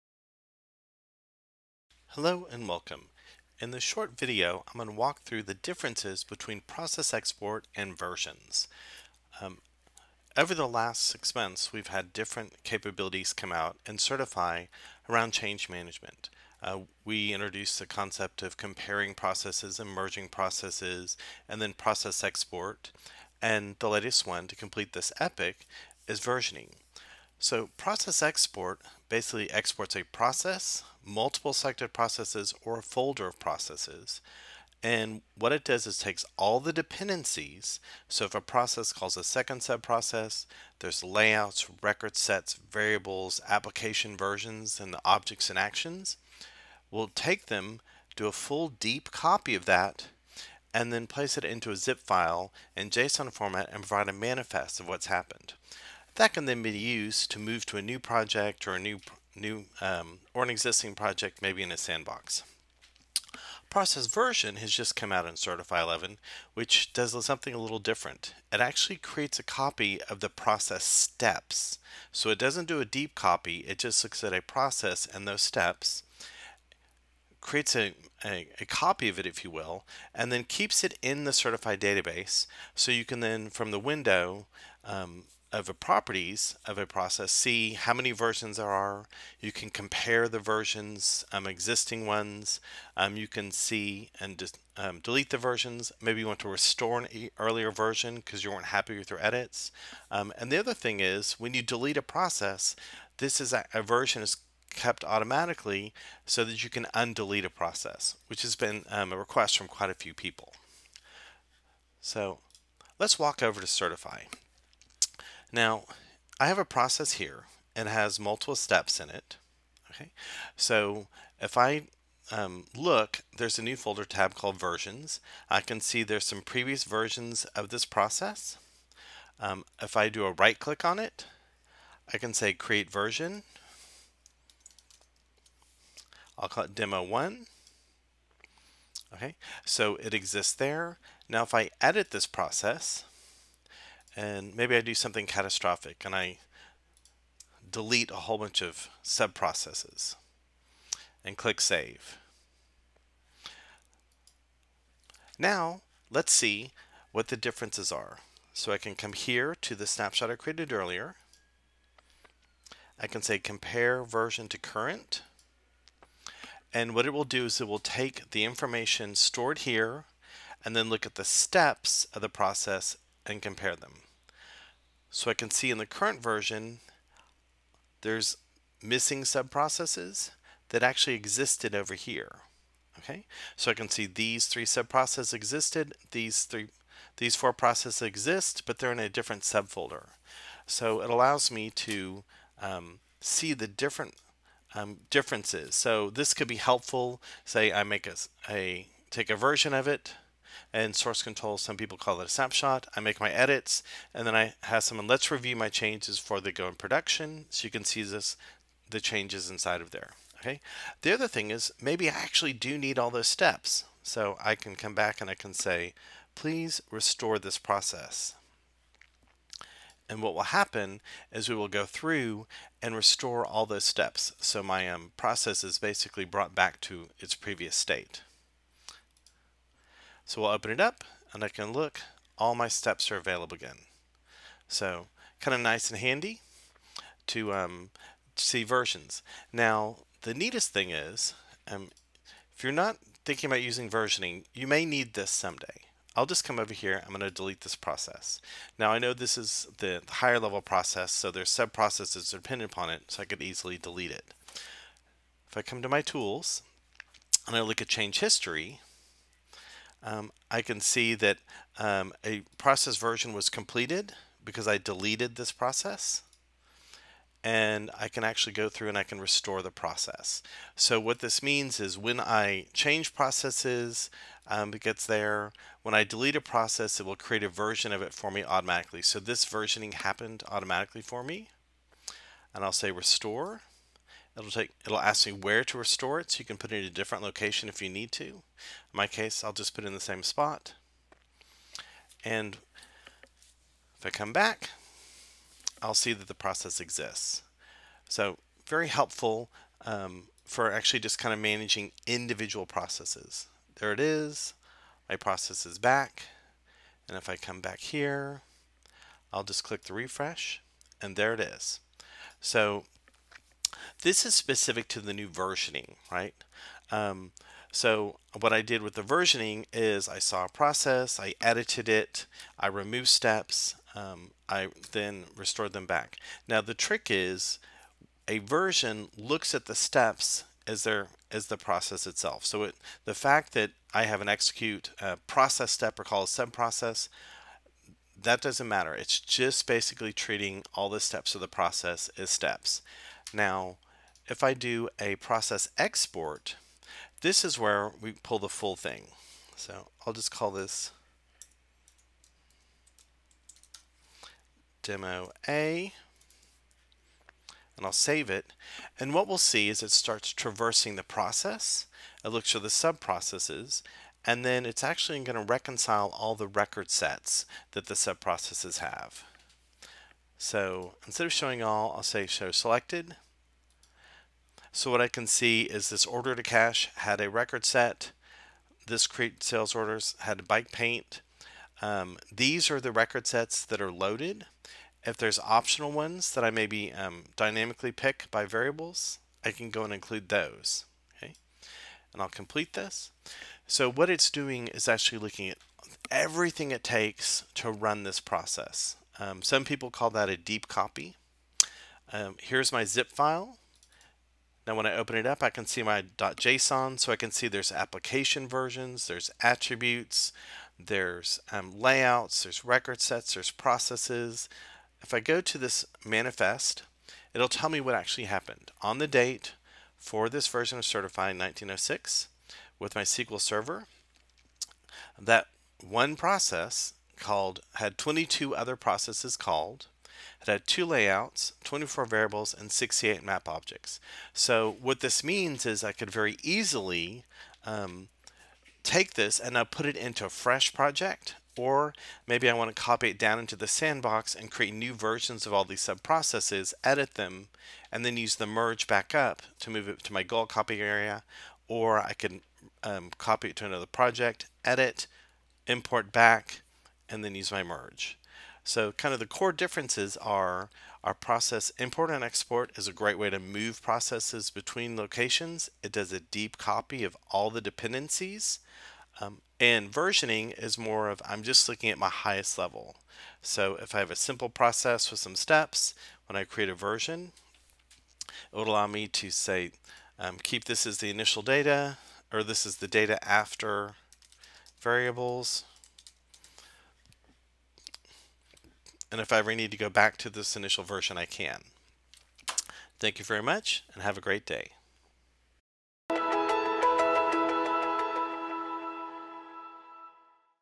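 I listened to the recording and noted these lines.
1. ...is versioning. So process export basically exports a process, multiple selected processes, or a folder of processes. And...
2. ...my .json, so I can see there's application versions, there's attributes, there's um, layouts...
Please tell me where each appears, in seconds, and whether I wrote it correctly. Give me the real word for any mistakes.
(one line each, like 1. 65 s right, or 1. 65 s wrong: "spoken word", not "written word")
1. 26 s right
2. 405 s right.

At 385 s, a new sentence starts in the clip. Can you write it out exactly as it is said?
If there's optional ones that I maybe um, dynamically pick by variables, I can go and include those.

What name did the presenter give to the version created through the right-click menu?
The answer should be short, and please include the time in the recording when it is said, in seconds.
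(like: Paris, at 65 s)
demo one, at 136 s.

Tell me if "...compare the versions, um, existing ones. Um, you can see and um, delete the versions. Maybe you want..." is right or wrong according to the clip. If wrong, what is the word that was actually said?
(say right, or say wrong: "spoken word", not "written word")
right.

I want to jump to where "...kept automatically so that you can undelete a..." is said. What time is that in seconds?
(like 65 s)
104 s.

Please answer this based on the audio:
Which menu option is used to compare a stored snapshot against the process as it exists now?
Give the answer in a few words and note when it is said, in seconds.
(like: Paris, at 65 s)
compare version to current, at 163 s.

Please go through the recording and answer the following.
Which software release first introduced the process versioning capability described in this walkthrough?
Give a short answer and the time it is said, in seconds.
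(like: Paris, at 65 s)
Certify 11, at 65 s.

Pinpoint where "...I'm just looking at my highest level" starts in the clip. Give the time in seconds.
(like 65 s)
471 s.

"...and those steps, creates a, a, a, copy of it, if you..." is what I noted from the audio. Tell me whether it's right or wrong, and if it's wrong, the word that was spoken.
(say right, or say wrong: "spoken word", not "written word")
right.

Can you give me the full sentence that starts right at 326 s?
Now the trick is a version looks at the steps as their as the process itself.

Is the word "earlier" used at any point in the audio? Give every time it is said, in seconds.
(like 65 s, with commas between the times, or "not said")
97 s, 160 s.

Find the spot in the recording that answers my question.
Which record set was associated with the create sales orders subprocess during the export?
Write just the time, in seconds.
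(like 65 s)
380 s.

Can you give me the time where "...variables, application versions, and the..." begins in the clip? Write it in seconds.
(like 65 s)
42 s.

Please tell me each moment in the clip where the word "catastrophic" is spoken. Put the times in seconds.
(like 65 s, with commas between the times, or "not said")
145 s.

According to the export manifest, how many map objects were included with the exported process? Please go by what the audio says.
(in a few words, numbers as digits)
68.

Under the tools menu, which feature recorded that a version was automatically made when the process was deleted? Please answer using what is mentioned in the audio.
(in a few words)
change history.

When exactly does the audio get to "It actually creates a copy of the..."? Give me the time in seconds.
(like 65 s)
68 s.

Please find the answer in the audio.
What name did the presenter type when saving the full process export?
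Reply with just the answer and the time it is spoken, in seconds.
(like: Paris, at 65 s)
demo A, at 354 s.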